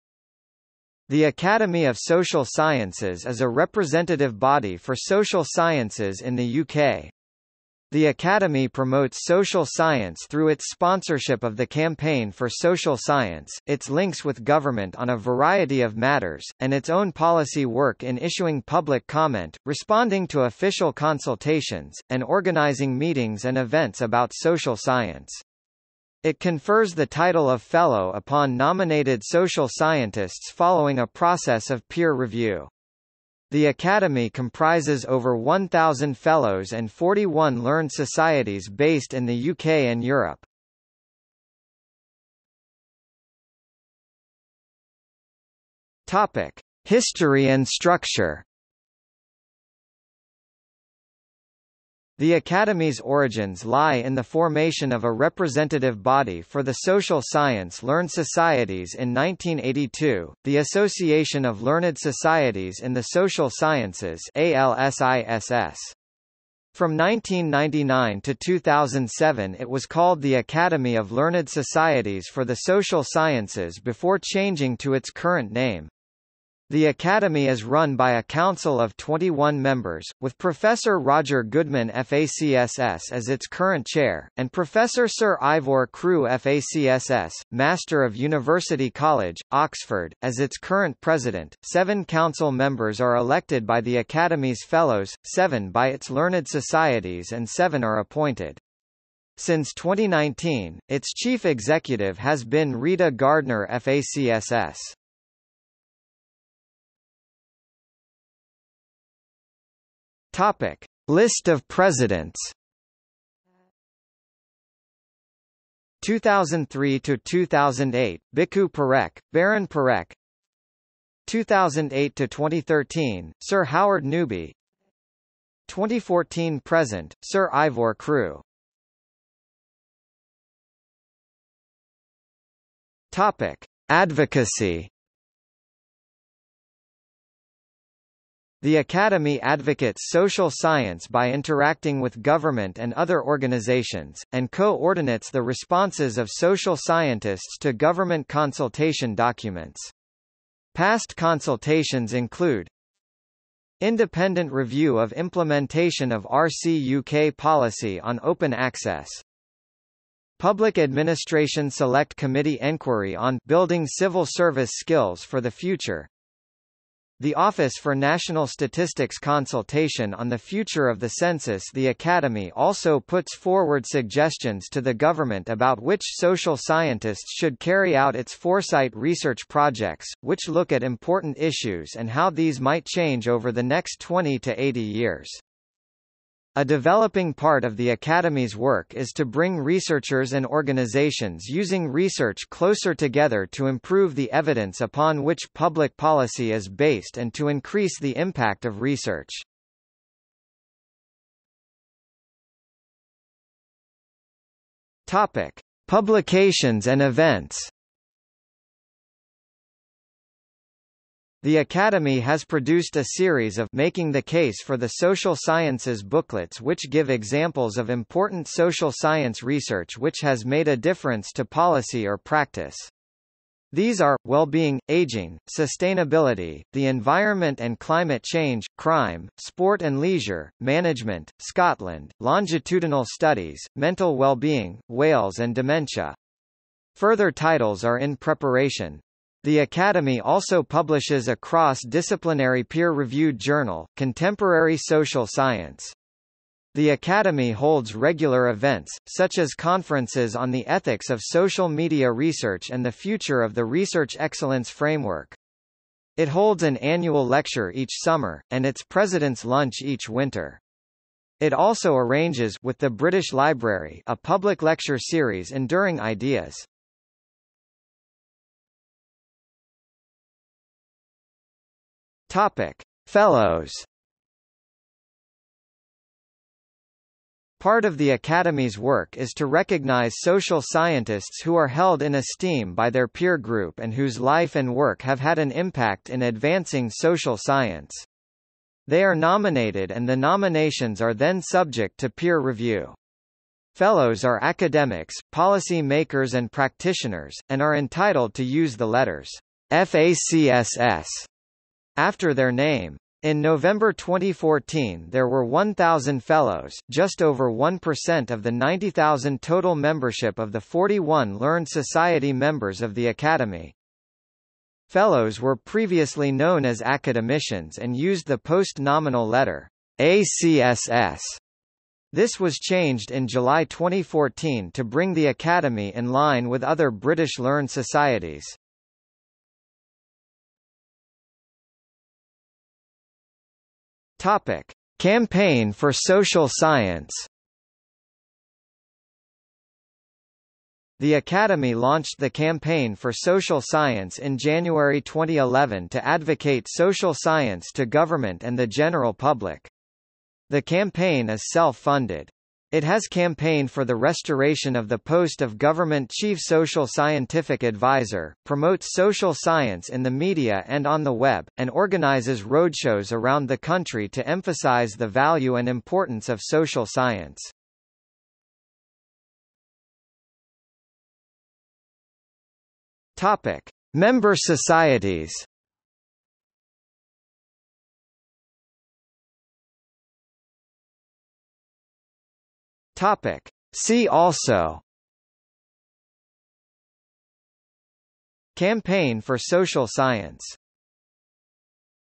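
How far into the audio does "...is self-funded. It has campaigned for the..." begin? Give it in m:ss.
5:51.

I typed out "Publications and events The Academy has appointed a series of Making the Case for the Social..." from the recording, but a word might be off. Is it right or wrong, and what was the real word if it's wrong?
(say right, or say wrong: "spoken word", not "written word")
wrong: "produced", not "appointed".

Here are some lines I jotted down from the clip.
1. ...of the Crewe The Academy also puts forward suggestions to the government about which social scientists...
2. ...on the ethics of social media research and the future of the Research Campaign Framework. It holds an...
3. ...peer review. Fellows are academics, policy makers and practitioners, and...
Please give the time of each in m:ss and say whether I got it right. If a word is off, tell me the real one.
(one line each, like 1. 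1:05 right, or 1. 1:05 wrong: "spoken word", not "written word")
1. 2:50 wrong: "Census", not "Crewe"
2. 4:10 wrong: "Excellence", not "Campaign"
3. 4:52 right.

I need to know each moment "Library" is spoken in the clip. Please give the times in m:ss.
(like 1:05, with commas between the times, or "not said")
4:23.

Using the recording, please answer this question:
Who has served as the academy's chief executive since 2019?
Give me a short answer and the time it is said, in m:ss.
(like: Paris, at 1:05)
Rita Gardner, at 1:42.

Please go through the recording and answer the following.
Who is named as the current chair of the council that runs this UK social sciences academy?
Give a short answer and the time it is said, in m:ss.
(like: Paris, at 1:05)
Roger Goodman, at 1:21.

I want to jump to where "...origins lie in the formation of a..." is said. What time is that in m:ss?
0:52.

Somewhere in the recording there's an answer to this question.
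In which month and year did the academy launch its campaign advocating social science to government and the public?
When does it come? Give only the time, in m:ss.
5:44.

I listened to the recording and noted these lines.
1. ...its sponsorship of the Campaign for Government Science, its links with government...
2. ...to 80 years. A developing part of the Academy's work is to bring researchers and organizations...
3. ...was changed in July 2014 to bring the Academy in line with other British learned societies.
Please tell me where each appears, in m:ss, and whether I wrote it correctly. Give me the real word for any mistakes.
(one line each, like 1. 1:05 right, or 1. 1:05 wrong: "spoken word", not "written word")
1. 0:10 wrong: "Social", not "Government"
2. 3:04 right
3. 5:22 right.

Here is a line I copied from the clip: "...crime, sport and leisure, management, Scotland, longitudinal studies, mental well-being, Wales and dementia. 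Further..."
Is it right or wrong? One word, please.
right.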